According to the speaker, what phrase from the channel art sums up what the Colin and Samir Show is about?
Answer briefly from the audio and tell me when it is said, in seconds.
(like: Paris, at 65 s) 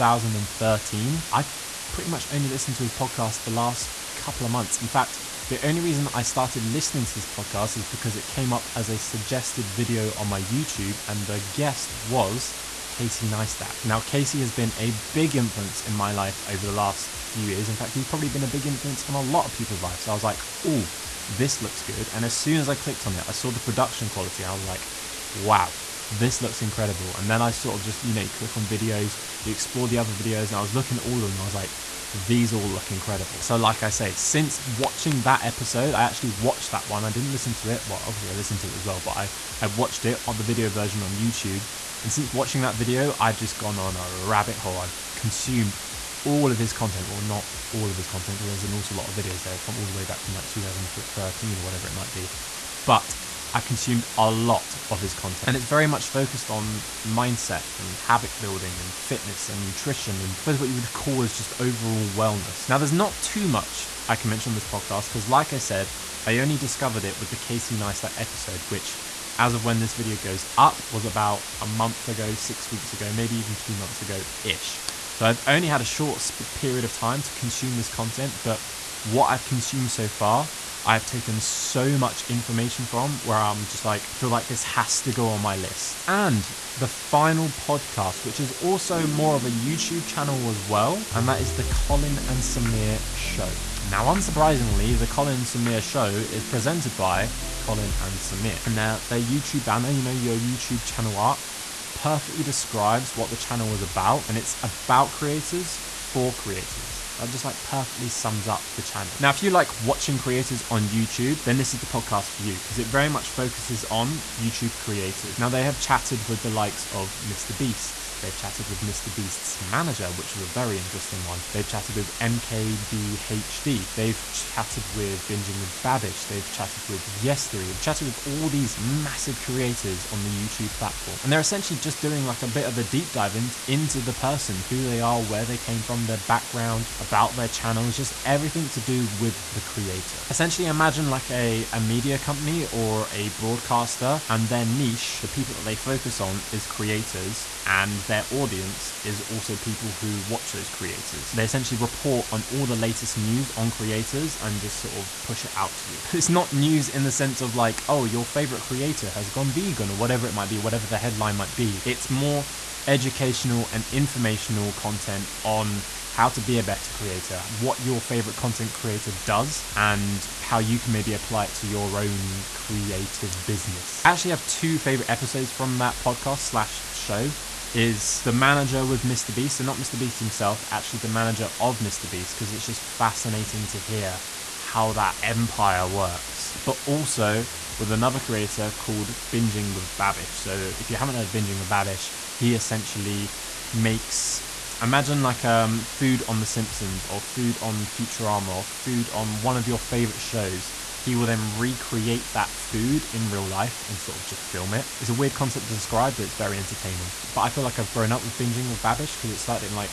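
creators for creators, at 105 s.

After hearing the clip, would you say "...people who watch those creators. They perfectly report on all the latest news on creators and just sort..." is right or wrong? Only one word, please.
wrong.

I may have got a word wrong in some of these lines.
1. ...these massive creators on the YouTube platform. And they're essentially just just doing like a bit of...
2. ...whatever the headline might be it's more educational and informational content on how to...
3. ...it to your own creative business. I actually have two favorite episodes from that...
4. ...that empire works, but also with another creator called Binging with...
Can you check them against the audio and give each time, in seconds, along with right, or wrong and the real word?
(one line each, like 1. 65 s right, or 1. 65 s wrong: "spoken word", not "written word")
1. 128 s right
2. 160 s right
3. 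171 s right
4. 184 s right.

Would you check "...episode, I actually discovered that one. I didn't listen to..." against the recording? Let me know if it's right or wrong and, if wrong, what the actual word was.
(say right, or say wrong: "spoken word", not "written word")
wrong: "watched", not "discovered".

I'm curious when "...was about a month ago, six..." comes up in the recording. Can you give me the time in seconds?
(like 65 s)
70 s.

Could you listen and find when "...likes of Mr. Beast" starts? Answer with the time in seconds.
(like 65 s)
116 s.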